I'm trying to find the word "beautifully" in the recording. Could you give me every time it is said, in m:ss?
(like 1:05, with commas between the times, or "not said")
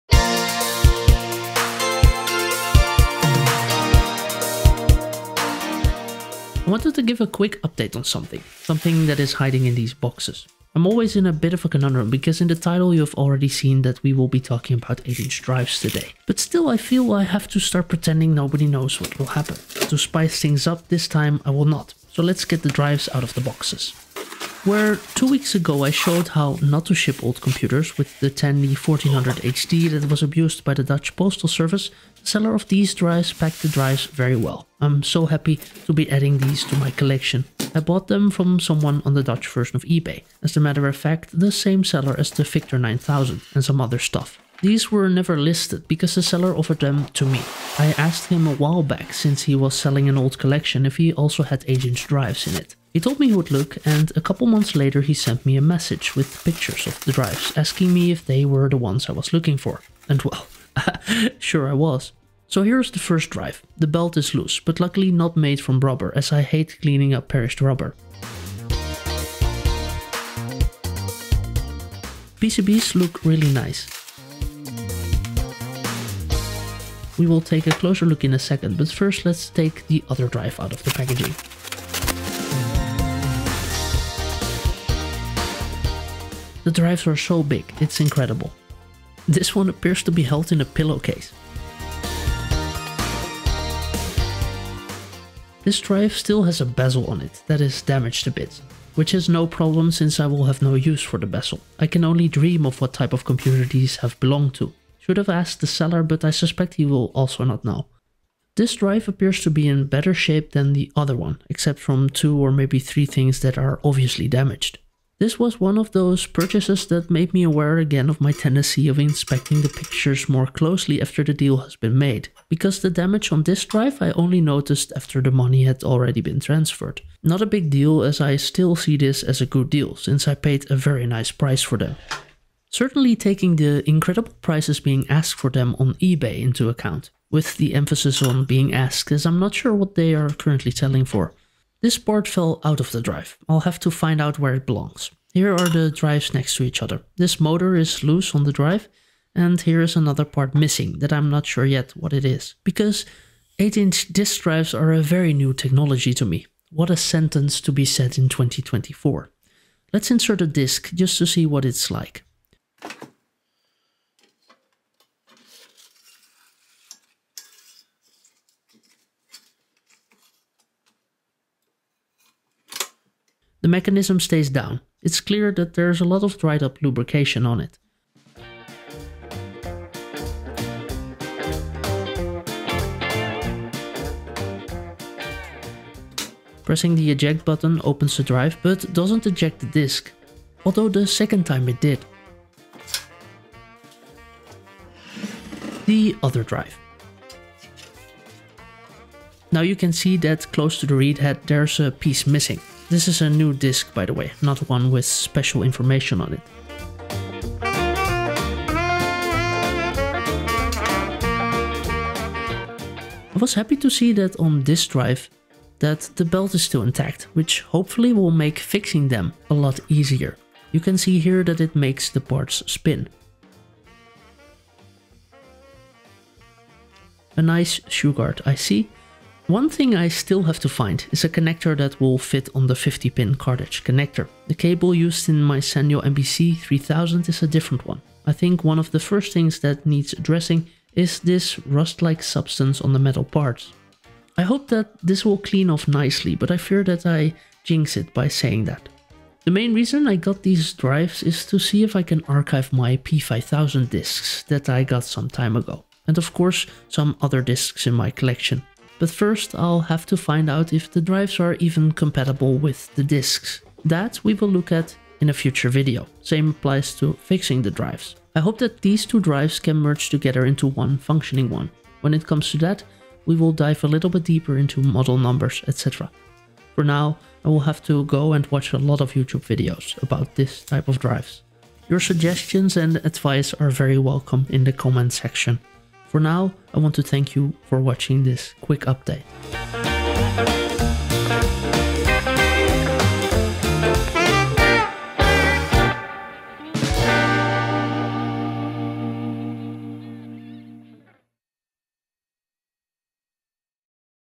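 not said.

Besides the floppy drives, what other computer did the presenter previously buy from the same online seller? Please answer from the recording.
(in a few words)
Victor 9000.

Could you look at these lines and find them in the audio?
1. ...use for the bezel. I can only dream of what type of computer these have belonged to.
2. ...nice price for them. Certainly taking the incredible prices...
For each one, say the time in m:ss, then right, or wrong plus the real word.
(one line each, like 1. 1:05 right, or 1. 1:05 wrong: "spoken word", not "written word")
1. 1:40 right
2. 2:11 right.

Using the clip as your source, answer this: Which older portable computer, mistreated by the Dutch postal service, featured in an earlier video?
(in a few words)
Tandy 1400 HD.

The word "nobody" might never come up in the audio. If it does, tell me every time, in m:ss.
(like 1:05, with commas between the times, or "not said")
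0:18.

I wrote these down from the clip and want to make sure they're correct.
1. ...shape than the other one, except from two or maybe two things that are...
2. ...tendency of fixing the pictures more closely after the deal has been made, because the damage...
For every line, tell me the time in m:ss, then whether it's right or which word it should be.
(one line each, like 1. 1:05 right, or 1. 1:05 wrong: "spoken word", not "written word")
1. 1:50 wrong: "three", not "two"
2. 1:58 wrong: "inspecting", not "fixing".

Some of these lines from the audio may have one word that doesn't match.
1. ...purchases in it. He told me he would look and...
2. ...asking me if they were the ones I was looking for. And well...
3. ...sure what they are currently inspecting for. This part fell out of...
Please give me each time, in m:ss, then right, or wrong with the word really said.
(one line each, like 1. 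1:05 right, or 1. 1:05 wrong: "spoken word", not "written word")
1. 0:52 wrong: "drives", not "purchases"
2. 0:57 right
3. 2:19 wrong: "selling", not "inspecting".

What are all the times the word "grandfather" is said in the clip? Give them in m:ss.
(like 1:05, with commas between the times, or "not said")
not said.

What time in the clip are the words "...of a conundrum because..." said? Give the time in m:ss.
0:11.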